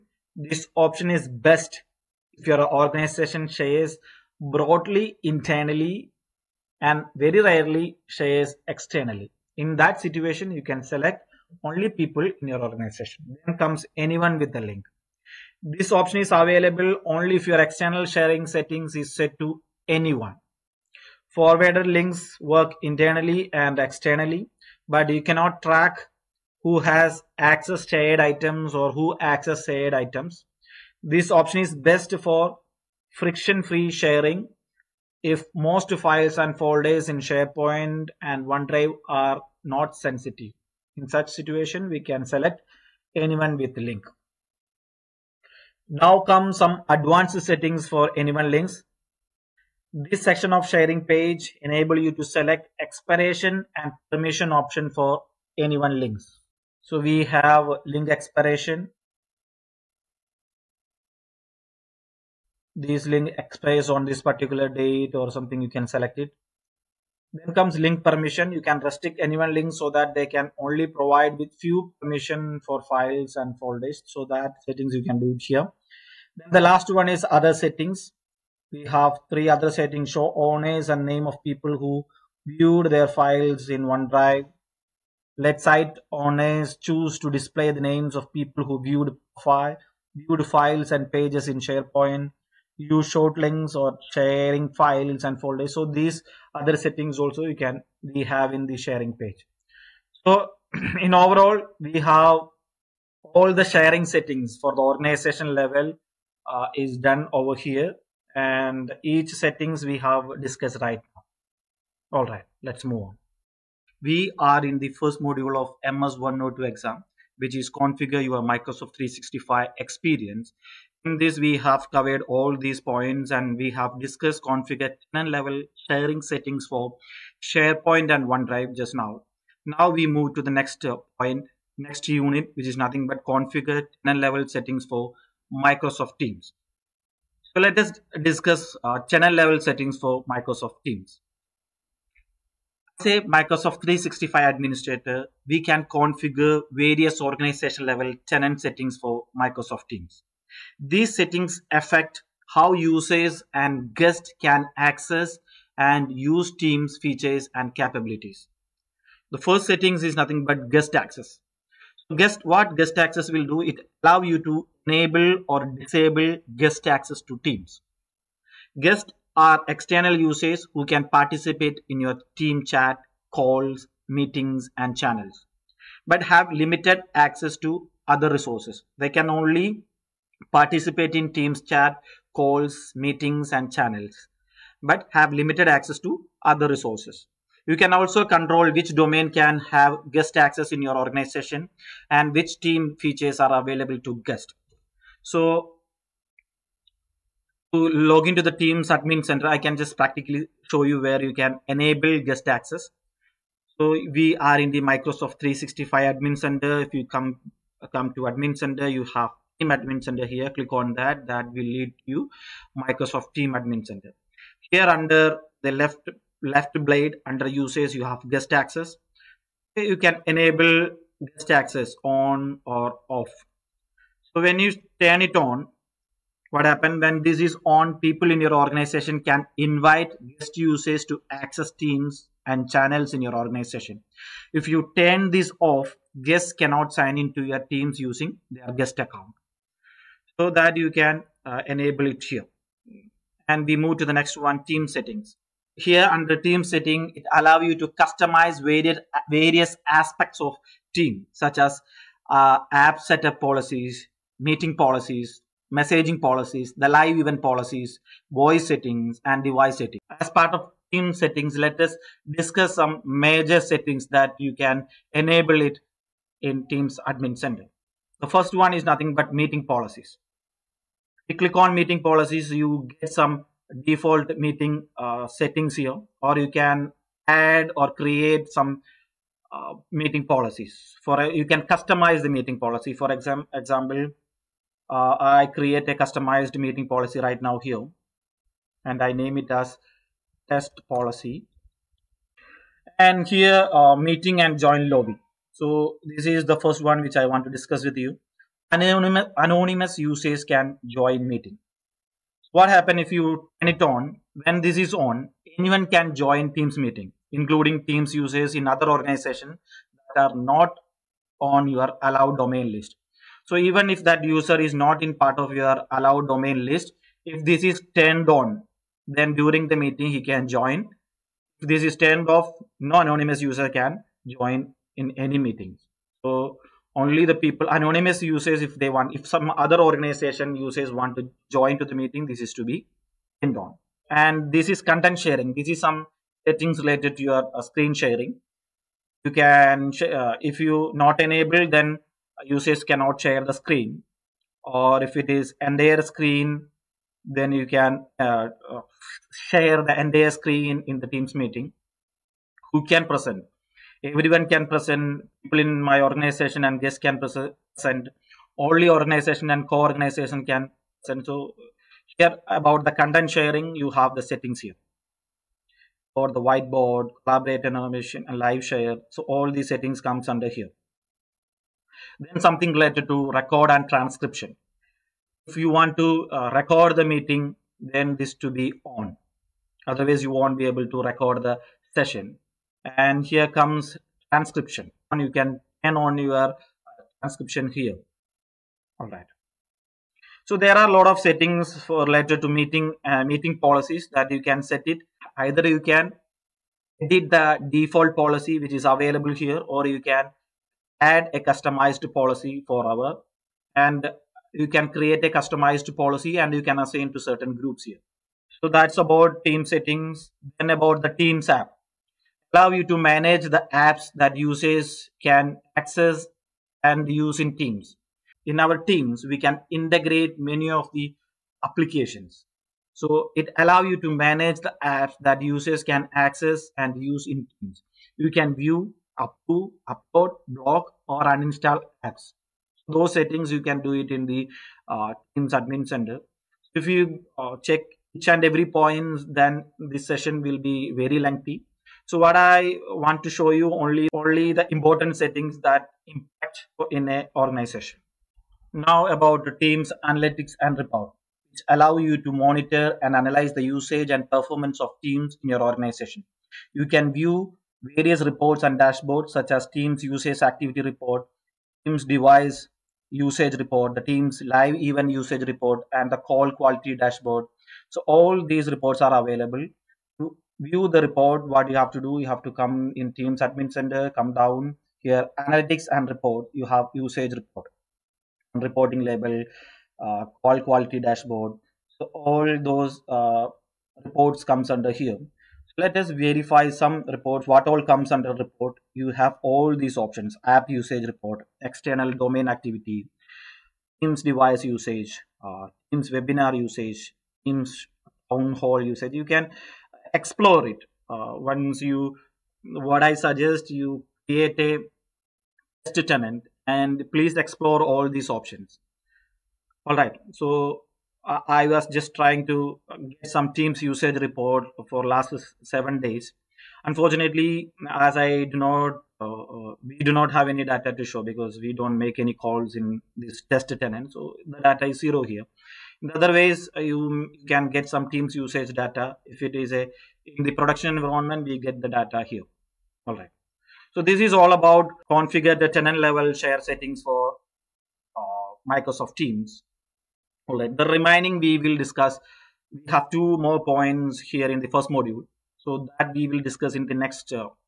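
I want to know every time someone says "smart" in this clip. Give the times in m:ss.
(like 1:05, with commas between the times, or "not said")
not said.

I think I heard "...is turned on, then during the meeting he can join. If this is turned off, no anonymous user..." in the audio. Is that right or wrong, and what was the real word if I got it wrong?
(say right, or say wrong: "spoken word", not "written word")
right.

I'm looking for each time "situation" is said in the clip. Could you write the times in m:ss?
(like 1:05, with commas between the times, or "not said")
0:10, 0:41.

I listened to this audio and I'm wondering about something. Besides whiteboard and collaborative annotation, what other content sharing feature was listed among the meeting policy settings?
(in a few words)
Live share.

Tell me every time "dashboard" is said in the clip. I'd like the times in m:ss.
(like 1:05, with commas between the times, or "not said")
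7:38, 7:46, 8:00.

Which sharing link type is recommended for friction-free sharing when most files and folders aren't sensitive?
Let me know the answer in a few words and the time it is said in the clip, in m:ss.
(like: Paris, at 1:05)
Anyone with the link, at 0:43.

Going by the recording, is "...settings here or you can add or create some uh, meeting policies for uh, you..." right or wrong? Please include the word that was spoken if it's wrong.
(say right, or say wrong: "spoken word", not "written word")
right.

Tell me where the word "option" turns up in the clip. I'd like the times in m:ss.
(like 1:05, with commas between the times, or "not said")
0:00, 0:15, 0:31, 0:54, 8:09, 8:28.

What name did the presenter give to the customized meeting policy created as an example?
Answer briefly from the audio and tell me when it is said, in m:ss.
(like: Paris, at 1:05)
test policy, at 4:50.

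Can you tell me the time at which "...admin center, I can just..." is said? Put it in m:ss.
3:18.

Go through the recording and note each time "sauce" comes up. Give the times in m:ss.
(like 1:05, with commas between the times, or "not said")
not said.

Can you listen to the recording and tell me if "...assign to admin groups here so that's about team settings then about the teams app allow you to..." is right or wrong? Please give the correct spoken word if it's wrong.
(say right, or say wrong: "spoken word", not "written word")
wrong: "certain", not "admin".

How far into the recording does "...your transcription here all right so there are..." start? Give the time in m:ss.
6:26.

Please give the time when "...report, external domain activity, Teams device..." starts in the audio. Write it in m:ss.
8:11.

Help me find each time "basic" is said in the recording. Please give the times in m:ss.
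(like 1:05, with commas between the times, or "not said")
not said.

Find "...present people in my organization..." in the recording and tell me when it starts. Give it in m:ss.
5:54.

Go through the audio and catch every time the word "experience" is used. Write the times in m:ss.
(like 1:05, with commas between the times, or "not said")
1:59.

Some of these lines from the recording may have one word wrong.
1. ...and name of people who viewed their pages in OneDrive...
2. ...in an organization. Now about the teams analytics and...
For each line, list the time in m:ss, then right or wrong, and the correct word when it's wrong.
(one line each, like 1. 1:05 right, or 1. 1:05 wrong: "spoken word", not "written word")
1. 1:20 wrong: "files", not "pages"
2. 7:26 right.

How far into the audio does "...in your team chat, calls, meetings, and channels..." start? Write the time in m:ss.
2:51.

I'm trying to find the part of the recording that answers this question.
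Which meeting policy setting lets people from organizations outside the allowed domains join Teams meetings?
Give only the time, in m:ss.
4:59.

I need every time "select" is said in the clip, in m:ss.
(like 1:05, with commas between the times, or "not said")
0:10, 0:42, 0:52, 1:05.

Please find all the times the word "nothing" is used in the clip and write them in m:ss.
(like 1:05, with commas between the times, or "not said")
2:12, 2:40, 4:28.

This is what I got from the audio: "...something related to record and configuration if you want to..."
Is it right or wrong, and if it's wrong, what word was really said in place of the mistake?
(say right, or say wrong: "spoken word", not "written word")
wrong: "transcription", not "configuration".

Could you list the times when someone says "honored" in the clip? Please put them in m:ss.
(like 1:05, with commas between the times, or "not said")
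not said.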